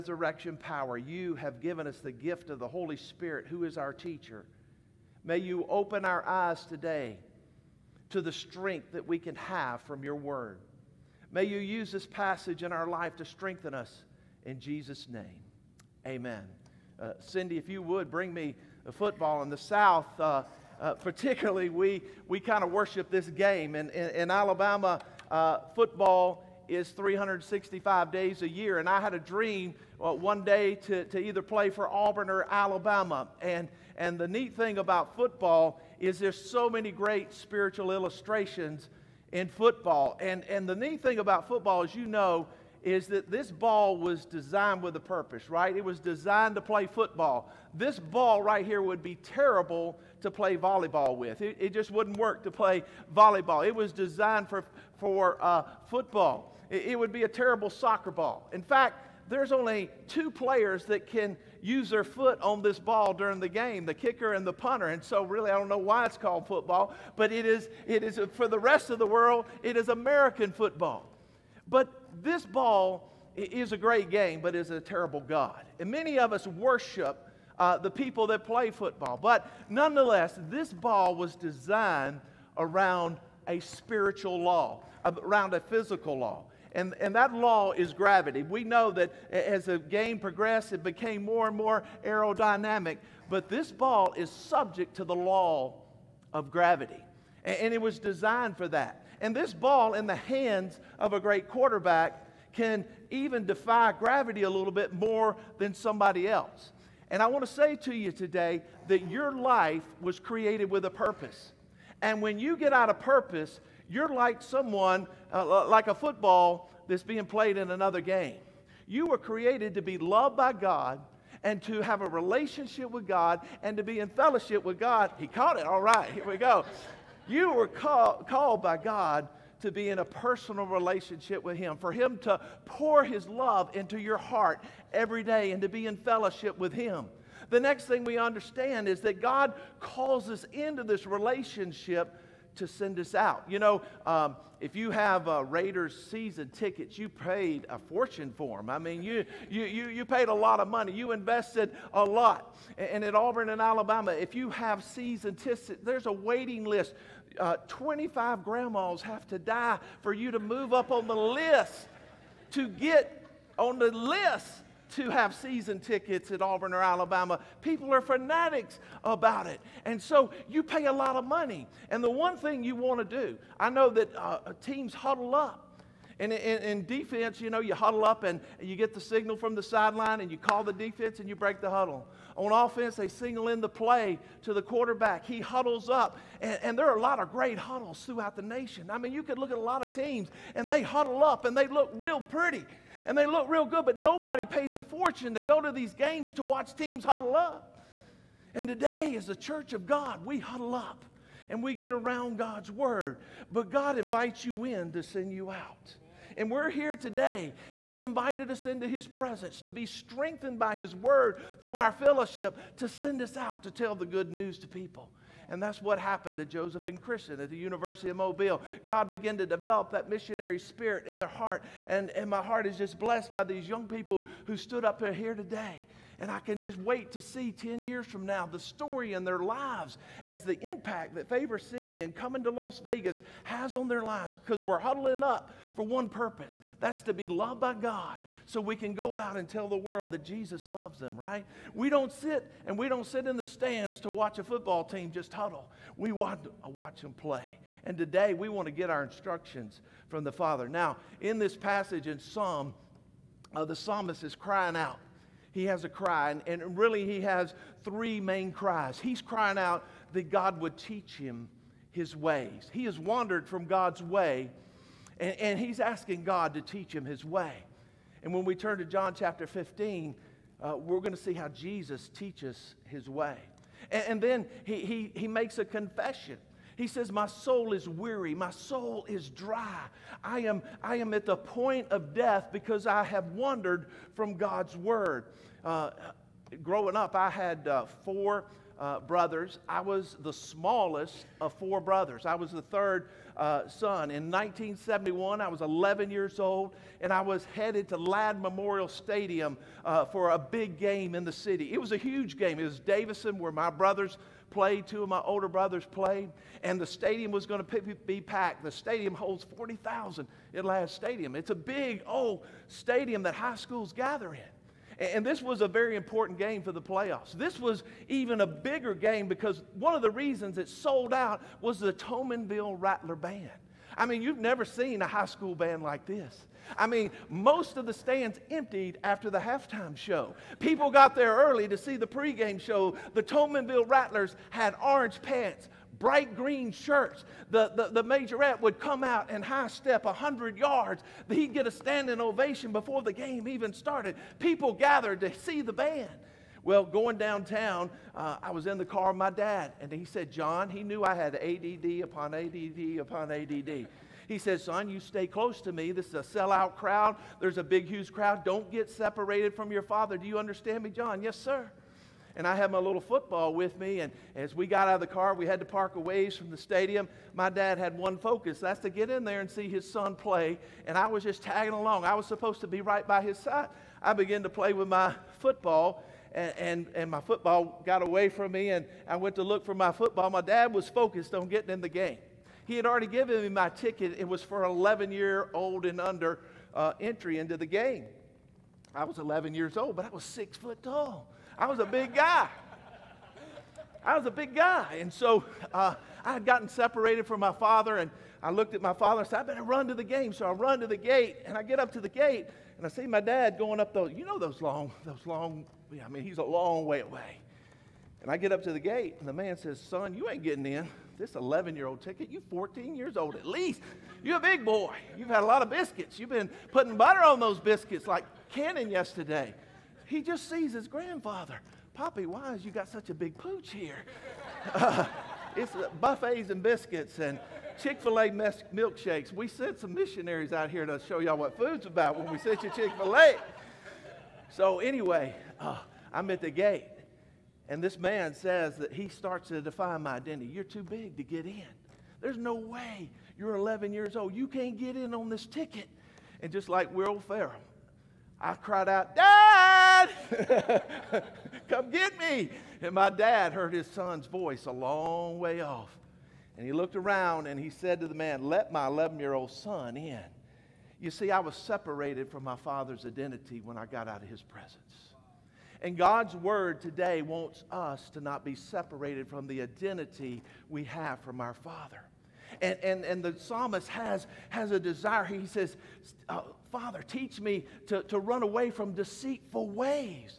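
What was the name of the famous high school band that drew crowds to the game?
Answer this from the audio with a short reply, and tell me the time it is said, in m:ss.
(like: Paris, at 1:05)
Toulminville Rattler Band, at 5:21.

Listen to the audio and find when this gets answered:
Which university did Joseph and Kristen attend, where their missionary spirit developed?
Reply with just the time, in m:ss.
3:37.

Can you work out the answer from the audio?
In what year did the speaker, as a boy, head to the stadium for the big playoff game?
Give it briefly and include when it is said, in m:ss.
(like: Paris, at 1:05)
1971, at 4:54.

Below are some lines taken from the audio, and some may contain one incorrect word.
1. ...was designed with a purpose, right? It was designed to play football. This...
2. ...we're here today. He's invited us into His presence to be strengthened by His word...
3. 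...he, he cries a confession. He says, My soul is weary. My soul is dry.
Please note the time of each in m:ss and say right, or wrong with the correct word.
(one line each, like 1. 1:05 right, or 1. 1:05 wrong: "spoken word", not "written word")
1. 0:43 right
2. 3:26 right
3. 4:34 wrong: "makes", not "cries".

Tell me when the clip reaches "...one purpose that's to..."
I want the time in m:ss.
3:55.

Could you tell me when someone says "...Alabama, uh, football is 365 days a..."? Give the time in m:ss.
0:24.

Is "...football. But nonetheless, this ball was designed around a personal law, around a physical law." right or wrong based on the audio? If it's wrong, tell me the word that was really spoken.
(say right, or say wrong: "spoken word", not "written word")
wrong: "spiritual", not "personal".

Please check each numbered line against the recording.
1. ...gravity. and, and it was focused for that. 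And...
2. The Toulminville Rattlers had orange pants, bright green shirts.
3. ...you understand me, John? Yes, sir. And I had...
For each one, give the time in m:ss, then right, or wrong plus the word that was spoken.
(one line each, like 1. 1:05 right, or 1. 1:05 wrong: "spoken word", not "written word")
1. 1:36 wrong: "designed", not "focused"
2. 5:33 right
3. 6:00 right.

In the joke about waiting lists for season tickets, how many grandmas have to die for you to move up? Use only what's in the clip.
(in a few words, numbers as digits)
25.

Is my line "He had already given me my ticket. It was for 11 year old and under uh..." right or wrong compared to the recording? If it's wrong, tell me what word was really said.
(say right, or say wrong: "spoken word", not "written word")
right.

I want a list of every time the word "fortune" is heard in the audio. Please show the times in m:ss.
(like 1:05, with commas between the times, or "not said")
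2:27, 3:14.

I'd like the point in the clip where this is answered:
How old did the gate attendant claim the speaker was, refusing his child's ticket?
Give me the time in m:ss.
6:52.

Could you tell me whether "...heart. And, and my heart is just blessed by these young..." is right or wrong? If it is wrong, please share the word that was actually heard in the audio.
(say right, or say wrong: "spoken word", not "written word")
right.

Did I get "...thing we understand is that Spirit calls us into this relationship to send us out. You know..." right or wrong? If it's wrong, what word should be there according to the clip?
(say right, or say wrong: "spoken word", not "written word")
wrong: "God", not "Spirit".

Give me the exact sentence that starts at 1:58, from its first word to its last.
You were created to be loved by God and to have a relationship with God and to be in fellowship with God.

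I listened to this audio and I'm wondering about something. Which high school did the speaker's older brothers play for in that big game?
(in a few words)
Davidson.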